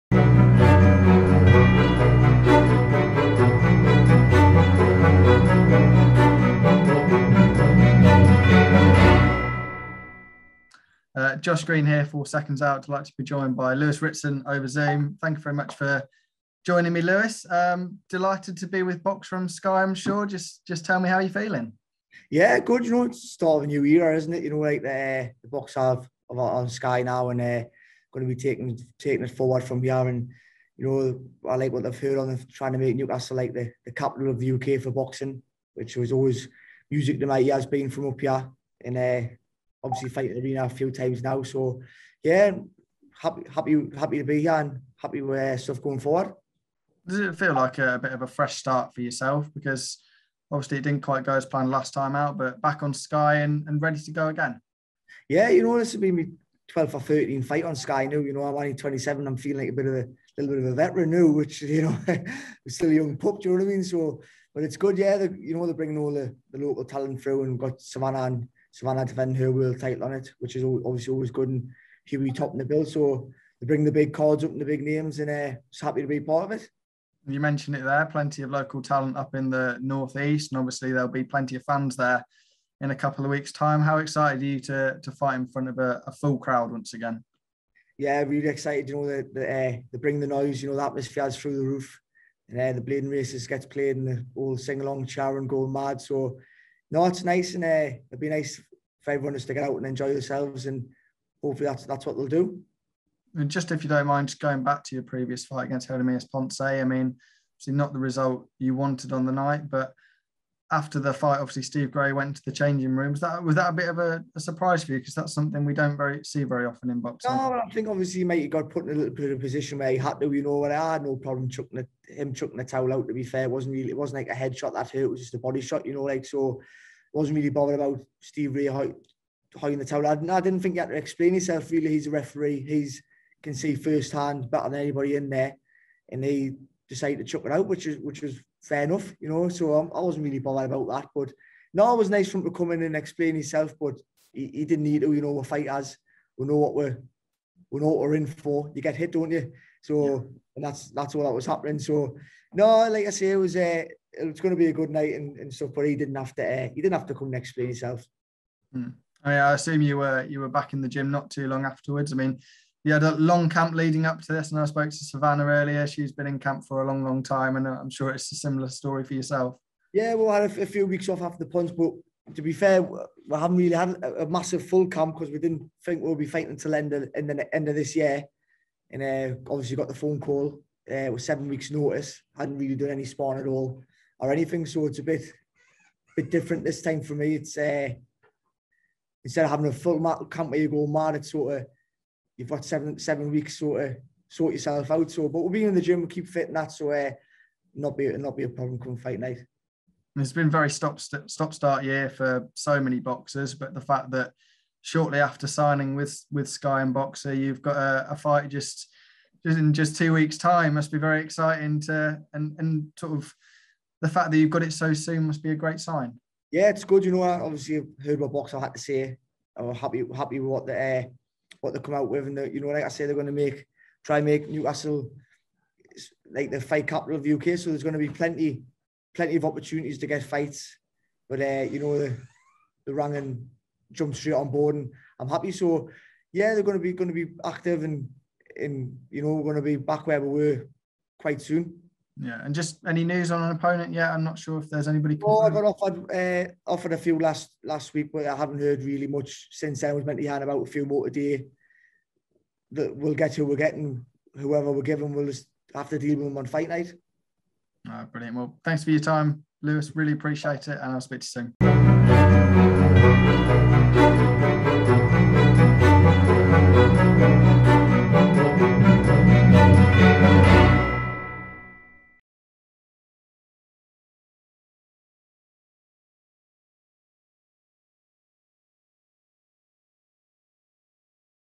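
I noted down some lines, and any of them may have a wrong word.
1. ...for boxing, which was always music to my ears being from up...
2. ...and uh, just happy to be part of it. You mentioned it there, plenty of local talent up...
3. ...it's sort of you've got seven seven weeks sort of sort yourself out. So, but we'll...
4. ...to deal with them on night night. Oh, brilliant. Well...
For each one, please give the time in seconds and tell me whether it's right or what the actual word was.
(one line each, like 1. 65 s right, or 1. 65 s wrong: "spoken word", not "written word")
1. 34 s right
2. 75 s right
3. 191 s right
4. 255 s wrong: "fight", not "night".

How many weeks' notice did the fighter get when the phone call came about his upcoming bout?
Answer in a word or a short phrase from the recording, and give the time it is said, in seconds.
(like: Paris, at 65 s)
7, at 181 s.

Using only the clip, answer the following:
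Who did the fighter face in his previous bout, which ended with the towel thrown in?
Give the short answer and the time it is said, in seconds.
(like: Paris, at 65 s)
Jeremias Ponce, at 105 s.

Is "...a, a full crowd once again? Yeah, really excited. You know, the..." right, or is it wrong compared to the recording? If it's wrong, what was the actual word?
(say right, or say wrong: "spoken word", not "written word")
right.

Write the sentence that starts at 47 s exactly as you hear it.
Does it feel like a, bit of a fresh start for yourself?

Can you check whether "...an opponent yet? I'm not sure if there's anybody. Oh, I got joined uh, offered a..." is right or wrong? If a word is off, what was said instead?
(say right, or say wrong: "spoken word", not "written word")
wrong: "offered", not "joined".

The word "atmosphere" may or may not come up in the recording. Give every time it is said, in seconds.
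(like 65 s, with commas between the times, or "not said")
90 s.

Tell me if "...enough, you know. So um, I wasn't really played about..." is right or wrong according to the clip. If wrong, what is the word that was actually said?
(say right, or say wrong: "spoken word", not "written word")
wrong: "bothered", not "played".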